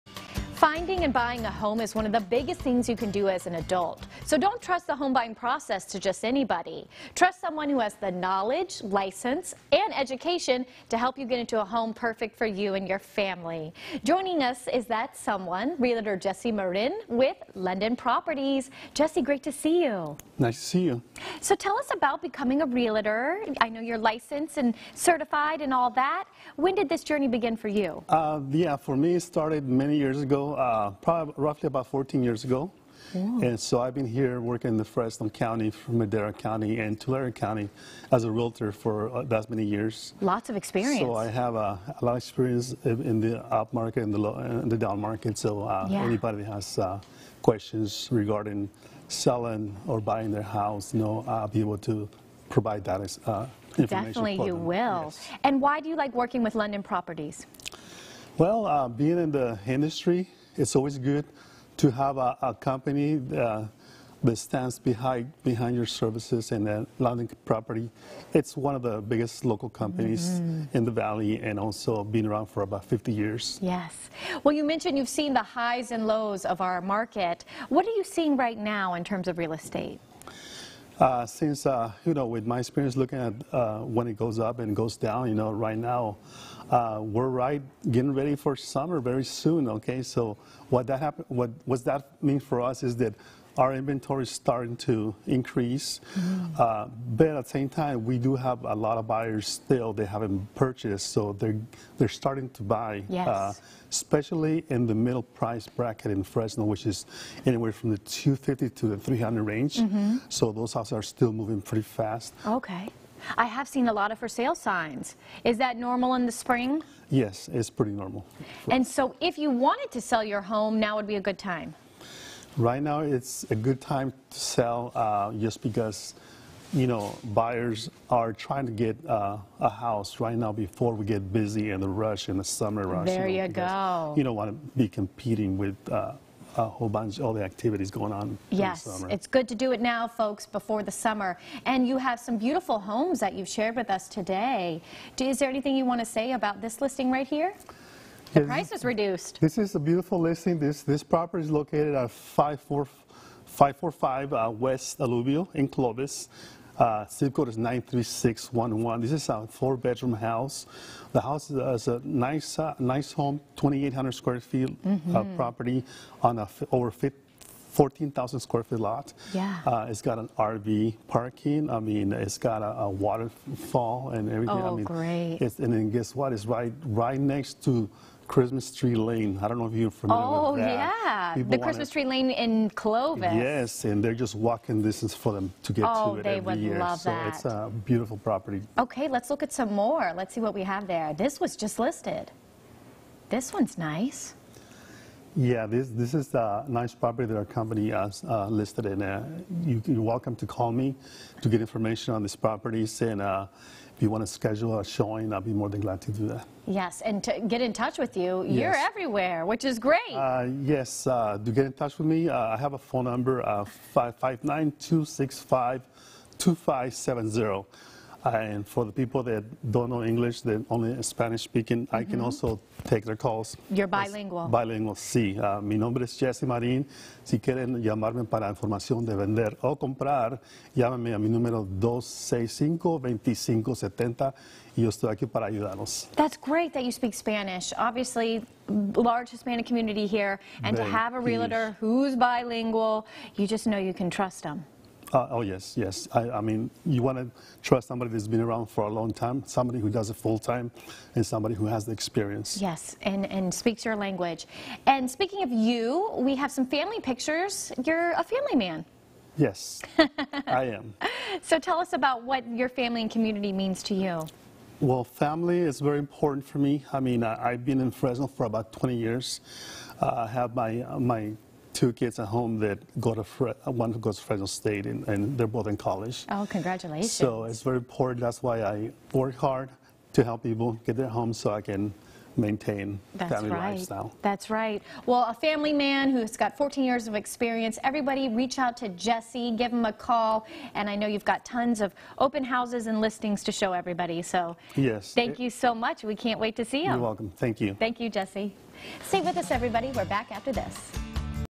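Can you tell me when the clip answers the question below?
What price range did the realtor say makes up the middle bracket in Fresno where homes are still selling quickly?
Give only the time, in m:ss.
1:47.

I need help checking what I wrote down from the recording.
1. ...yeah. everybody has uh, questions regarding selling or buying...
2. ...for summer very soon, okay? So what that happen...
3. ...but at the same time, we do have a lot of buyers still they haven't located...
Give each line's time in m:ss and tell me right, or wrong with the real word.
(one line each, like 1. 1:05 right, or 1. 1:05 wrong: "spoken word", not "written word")
1. 0:45 wrong: "anybody", not "everybody"
2. 1:28 right
3. 1:37 wrong: "purchased", not "located".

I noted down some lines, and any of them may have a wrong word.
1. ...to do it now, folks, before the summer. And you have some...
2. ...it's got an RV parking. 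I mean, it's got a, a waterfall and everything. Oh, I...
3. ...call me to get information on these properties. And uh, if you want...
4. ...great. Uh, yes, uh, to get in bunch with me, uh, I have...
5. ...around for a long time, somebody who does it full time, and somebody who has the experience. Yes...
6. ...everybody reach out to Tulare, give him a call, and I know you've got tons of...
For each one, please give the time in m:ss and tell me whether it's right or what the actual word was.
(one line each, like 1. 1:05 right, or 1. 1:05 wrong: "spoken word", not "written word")
1. 2:19 right
2. 2:49 right
3. 3:20 right
4. 3:29 wrong: "touch", not "bunch"
5. 4:08 right
6. 4:47 wrong: "Jesse", not "Tulare".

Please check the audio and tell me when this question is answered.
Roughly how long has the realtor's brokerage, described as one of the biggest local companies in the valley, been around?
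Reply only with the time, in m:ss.
1:12.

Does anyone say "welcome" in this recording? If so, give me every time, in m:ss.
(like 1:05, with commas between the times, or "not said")
3:20, 4:56.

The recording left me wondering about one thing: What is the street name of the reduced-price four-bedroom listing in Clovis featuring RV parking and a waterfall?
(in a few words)
West Alluvial.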